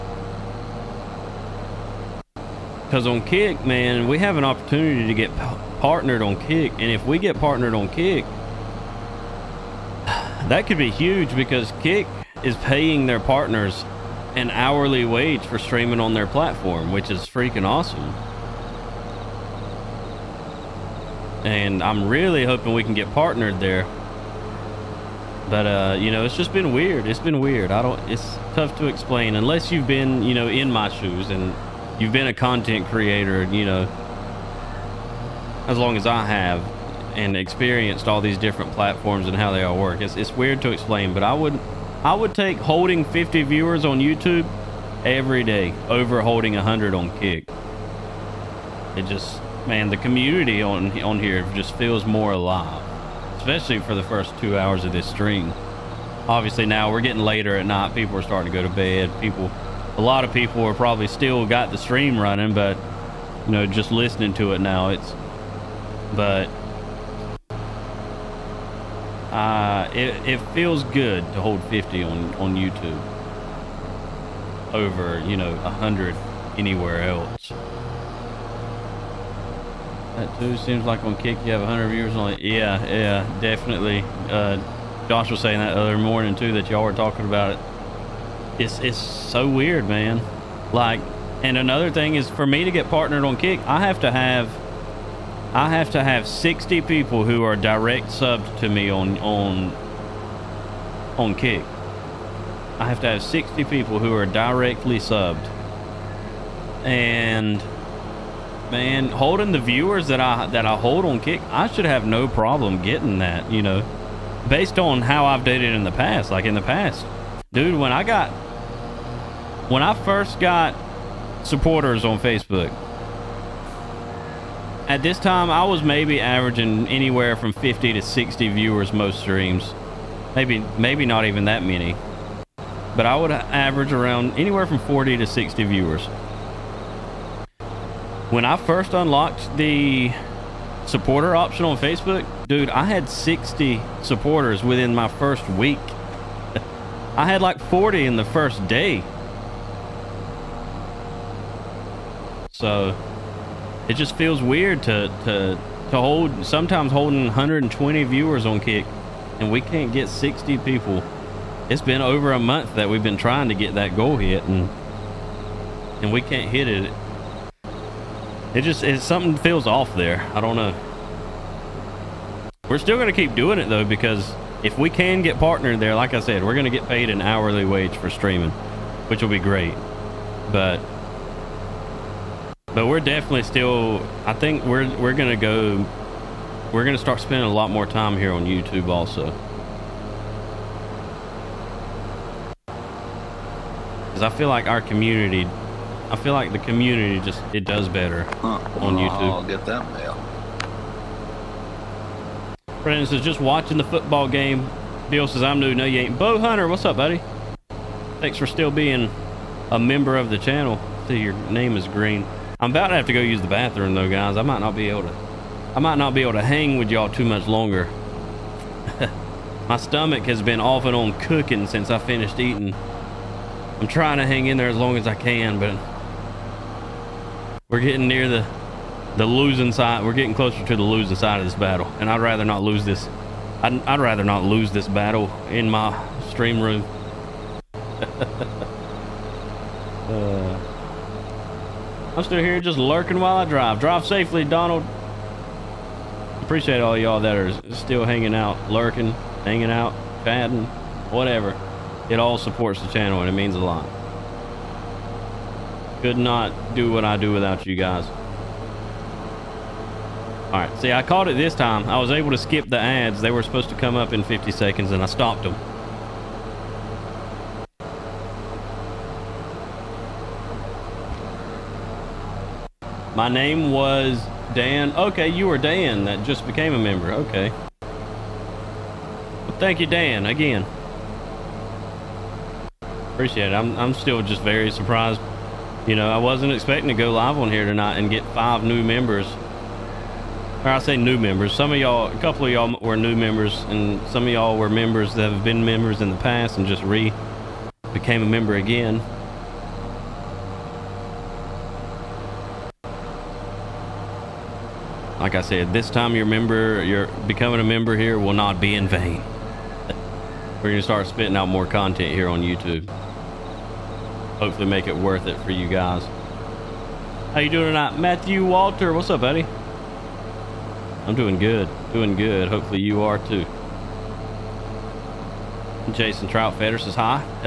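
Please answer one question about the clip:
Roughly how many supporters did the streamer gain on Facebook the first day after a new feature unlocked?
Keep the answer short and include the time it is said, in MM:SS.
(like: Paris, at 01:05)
40, at 02:27.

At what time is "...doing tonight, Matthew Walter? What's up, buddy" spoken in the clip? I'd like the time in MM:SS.
05:17.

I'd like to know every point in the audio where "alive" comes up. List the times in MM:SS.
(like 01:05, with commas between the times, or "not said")
00:52.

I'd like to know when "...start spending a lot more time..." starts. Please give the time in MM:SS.
03:07.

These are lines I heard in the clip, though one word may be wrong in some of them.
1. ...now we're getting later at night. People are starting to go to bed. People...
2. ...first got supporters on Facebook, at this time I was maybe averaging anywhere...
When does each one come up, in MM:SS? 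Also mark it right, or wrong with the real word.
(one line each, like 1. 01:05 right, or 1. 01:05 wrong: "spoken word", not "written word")
1. 00:56 right
2. 01:59 right.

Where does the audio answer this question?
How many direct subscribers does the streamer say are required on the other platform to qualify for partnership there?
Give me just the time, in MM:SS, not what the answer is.
01:35.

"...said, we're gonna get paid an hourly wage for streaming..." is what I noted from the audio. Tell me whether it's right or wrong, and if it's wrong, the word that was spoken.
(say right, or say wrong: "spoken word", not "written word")
right.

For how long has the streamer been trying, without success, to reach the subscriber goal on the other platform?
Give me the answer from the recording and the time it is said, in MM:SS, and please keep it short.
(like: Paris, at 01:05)
over a month, at 02:41.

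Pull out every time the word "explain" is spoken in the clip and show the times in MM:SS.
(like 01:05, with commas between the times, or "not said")
00:28, 00:40.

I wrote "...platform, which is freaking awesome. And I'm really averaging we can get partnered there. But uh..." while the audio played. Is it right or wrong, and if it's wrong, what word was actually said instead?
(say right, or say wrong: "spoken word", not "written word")
wrong: "hoping", not "averaging".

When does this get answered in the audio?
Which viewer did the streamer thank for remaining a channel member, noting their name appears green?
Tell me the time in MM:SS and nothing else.
03:26.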